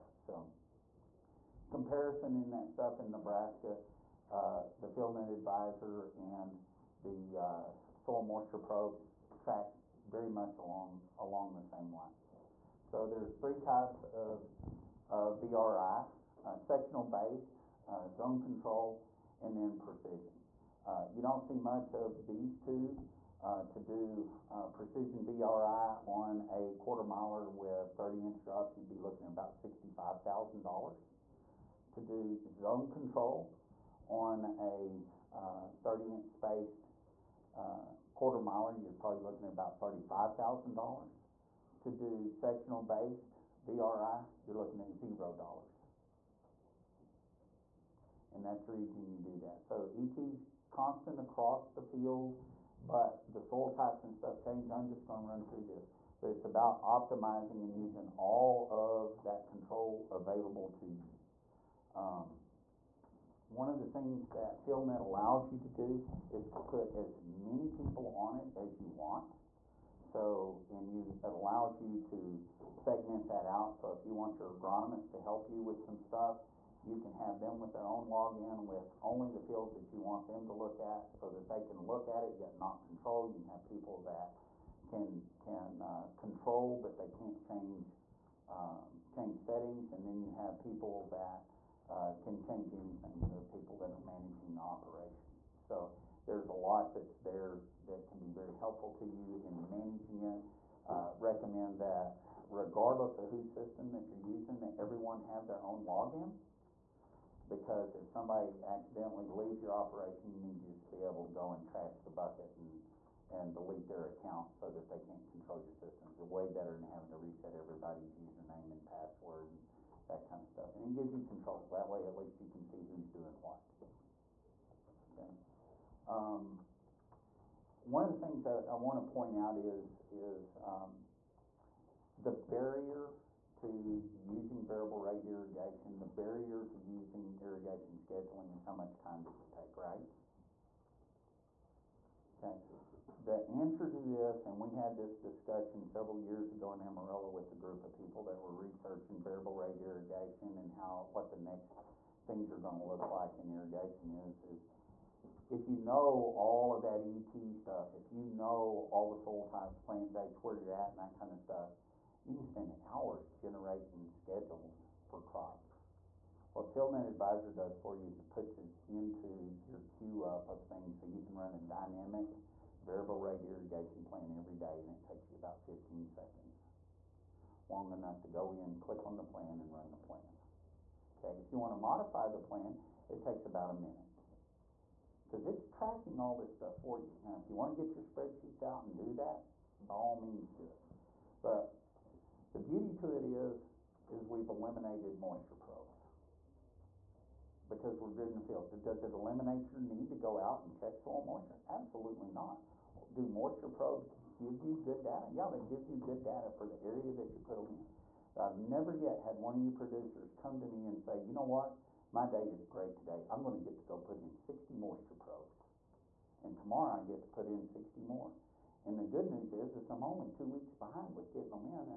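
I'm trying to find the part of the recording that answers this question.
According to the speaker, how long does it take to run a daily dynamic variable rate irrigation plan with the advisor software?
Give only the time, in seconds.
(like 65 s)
175 s.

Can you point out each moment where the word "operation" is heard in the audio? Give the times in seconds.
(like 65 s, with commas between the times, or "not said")
94 s, 109 s.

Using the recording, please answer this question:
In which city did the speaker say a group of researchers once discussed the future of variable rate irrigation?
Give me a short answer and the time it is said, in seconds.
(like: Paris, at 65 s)
Amarillo, at 146 s.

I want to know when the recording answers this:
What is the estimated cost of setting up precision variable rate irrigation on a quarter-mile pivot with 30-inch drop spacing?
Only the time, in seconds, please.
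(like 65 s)
29 s.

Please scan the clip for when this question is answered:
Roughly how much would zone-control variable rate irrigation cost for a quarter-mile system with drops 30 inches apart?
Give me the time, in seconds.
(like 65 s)
39 s.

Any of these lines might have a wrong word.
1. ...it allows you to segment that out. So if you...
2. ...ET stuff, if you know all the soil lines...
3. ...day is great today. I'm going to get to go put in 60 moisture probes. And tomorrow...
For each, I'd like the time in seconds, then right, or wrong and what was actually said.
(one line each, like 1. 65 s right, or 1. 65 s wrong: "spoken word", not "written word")
1. 71 s right
2. 157 s wrong: "types", not "lines"
3. 212 s right.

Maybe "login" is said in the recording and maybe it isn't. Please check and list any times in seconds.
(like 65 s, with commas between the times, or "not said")
78 s, 105 s.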